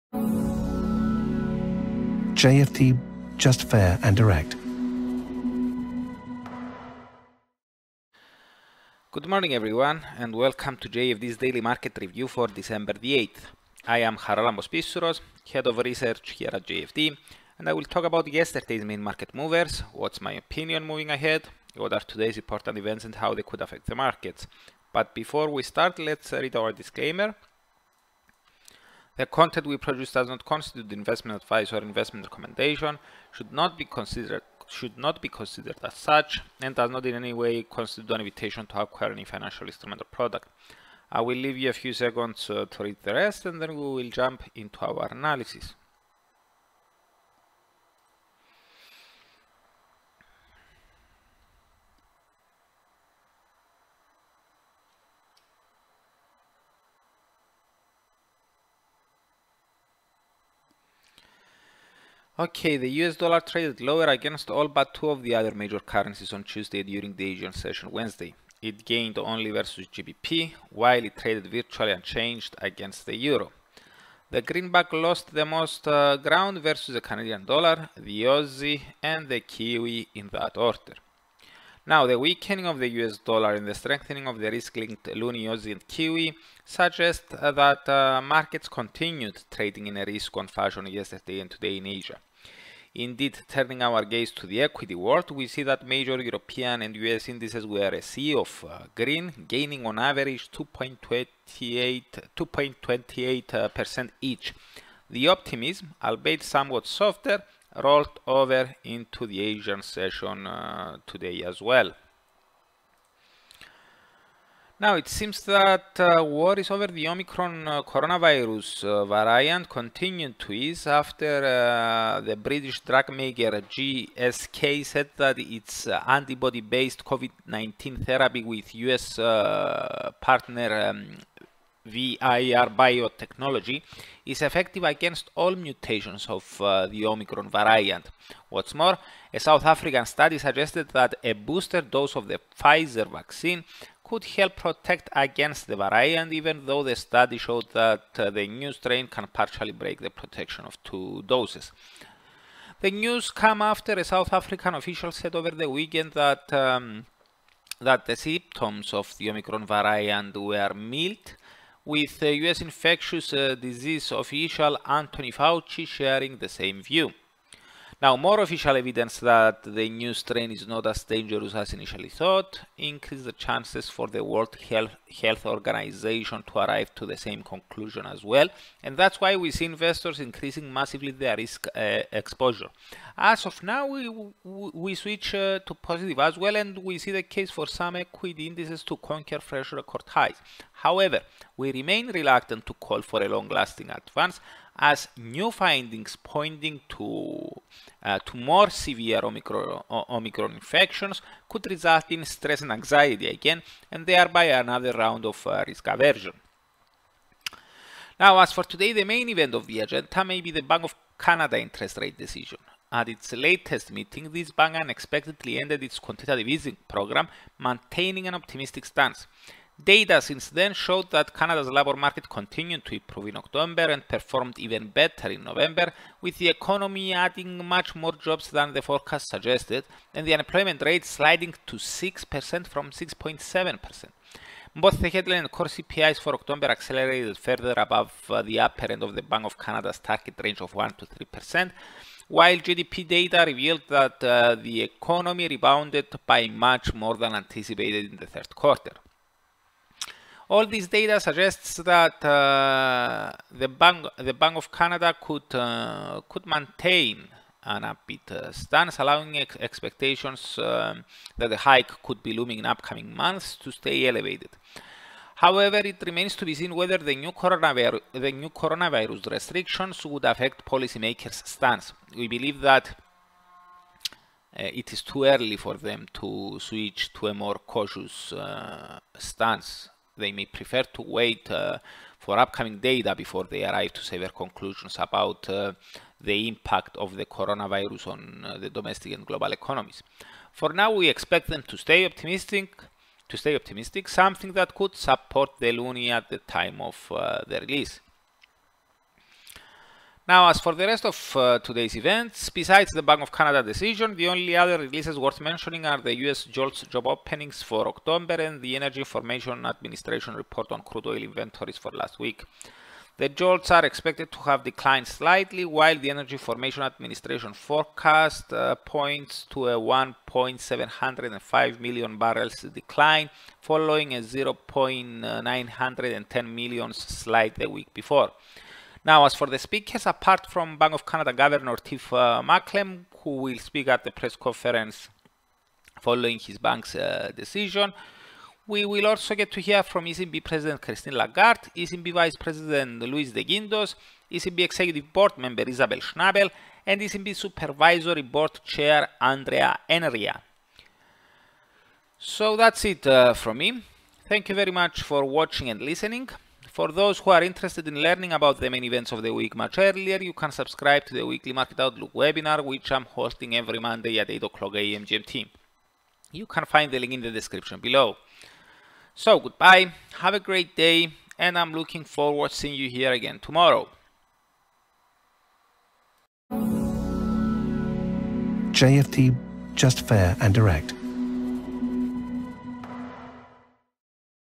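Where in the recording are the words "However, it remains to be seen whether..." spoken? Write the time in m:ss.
4:25.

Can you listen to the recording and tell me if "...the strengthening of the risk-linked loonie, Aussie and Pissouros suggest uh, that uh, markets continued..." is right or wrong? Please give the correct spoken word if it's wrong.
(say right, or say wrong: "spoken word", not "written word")
wrong: "Kiwi", not "Pissouros".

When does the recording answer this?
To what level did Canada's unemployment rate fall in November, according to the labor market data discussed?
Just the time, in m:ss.
3:51.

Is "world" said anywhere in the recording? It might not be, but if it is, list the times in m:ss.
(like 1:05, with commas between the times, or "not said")
1:34, 2:54.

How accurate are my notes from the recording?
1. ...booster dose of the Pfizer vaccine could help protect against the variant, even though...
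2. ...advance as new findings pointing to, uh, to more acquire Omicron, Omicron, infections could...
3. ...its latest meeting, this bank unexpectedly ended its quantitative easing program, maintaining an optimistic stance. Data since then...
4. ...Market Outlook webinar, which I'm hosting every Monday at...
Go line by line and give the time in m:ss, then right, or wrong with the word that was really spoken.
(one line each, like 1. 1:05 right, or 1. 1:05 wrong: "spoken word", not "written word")
1. 2:21 right
2. 3:13 wrong: "severe", not "acquire"
3. 3:33 right
4. 6:01 right.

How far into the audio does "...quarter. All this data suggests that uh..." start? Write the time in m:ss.
4:08.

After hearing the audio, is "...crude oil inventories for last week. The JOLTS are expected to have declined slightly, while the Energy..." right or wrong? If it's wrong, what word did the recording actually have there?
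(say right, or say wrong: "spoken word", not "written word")
right.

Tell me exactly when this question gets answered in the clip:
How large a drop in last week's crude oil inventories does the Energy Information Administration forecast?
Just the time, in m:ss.
5:19.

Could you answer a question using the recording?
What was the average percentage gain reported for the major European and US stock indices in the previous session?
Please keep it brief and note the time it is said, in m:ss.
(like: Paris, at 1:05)
2.28%, at 1:40.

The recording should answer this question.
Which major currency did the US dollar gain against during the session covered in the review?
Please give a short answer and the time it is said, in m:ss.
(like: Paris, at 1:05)
GBP, at 1:09.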